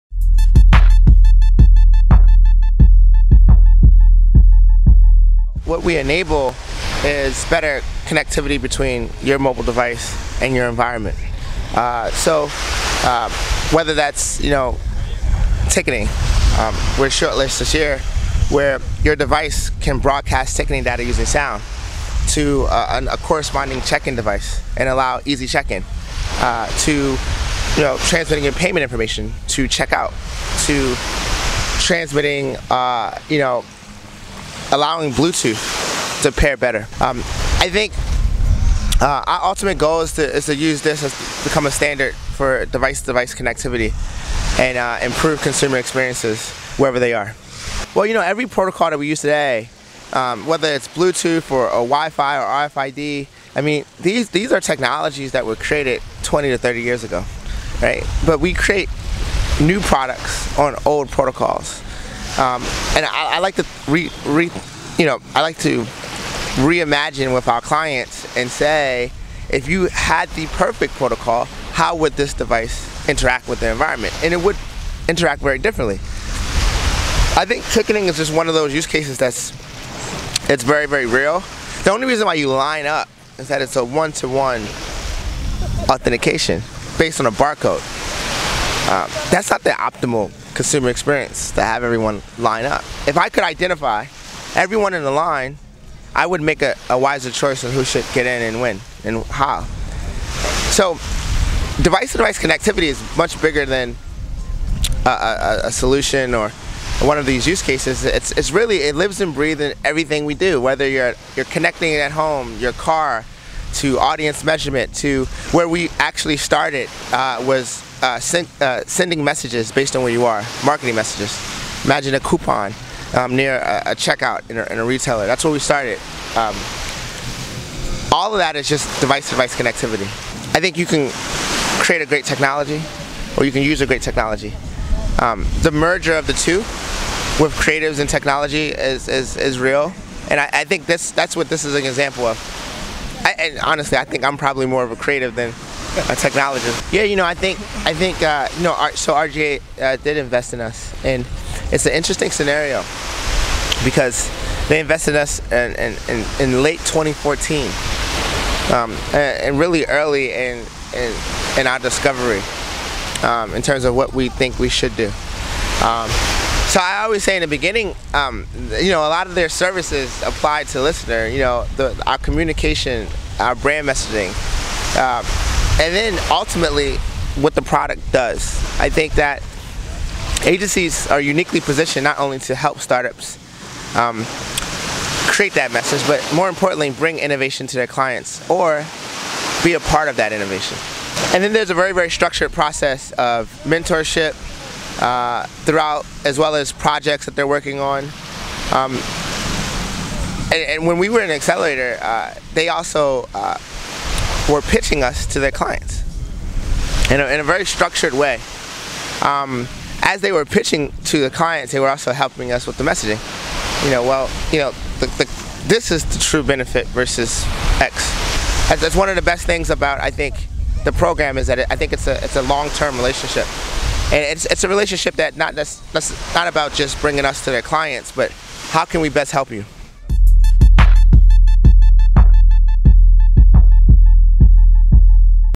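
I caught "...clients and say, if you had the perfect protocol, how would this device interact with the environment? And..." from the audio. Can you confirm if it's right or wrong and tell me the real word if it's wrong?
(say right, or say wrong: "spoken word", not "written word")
right.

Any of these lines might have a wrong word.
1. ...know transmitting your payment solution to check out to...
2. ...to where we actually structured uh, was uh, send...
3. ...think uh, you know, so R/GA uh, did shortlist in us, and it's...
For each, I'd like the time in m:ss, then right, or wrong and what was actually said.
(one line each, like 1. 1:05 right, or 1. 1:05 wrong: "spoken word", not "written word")
1. 0:27 wrong: "information", not "solution"
2. 1:54 wrong: "started", not "structured"
3. 2:27 wrong: "invest", not "shortlist".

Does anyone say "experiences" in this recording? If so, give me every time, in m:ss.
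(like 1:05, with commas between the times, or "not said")
0:45, 1:30.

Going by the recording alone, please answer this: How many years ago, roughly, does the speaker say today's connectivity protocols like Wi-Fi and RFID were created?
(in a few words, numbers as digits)
20 to 30 years.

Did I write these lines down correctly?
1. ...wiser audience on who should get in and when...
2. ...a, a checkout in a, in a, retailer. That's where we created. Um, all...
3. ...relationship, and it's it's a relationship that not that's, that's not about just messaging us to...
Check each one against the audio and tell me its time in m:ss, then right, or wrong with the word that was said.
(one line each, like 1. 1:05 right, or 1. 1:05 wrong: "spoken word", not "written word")
1. 1:36 wrong: "choice", not "audience"
2. 2:03 wrong: "started", not "created"
3. 3:42 wrong: "bringing", not "messaging".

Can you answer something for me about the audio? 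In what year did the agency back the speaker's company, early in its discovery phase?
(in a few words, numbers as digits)
2014.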